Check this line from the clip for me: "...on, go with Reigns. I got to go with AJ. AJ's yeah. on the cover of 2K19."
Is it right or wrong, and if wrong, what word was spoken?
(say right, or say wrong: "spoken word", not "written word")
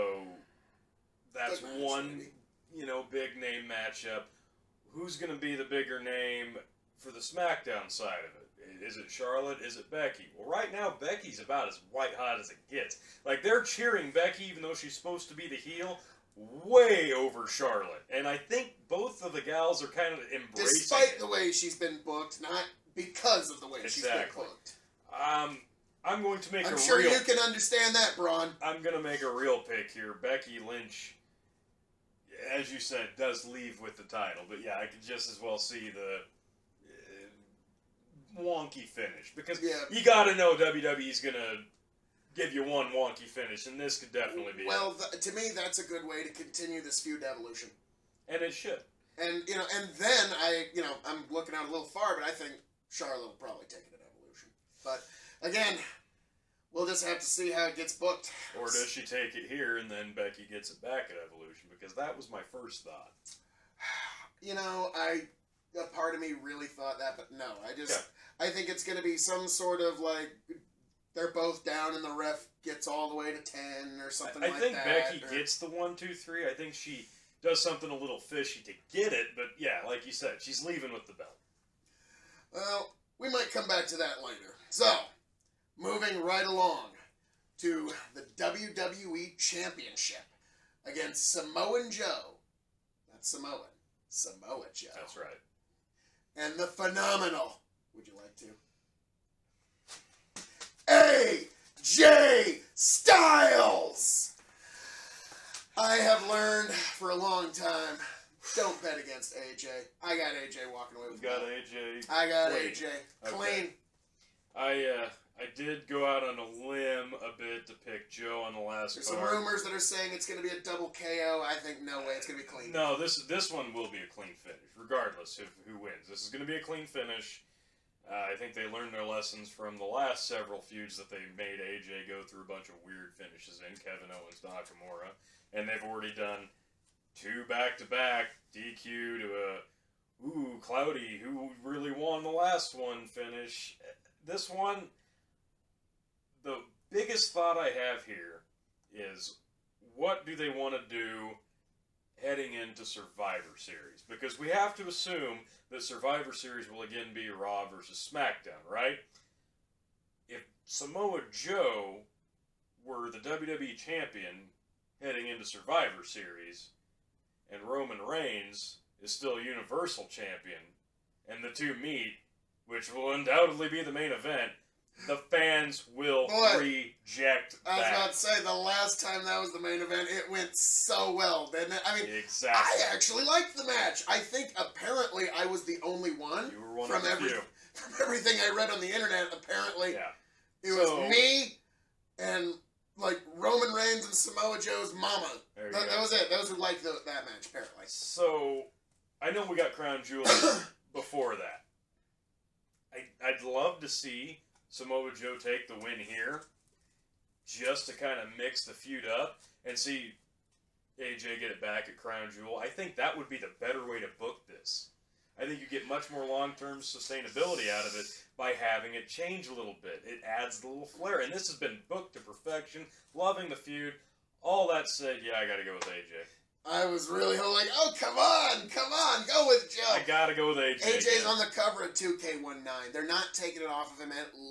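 wrong: "Joe", not "Reigns".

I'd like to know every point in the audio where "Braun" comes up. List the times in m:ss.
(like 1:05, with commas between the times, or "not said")
0:28.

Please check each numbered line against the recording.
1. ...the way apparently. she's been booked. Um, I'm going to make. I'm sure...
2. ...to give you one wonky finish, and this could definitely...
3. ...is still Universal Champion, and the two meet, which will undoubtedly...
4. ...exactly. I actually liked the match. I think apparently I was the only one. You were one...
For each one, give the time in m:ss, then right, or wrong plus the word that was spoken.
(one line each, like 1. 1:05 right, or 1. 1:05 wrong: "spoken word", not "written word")
1. 0:23 wrong: "exactly", not "apparently"
2. 0:41 right
3. 2:49 right
4. 3:02 right.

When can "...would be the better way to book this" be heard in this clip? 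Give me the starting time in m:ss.
3:33.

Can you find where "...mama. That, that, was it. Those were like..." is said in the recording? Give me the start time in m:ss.
3:14.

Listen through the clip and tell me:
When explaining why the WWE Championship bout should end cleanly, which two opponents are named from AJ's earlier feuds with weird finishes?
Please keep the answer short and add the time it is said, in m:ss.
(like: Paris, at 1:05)
Kevin Owens, Nakamura, at 2:13.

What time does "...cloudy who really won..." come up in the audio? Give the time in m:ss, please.
2:20.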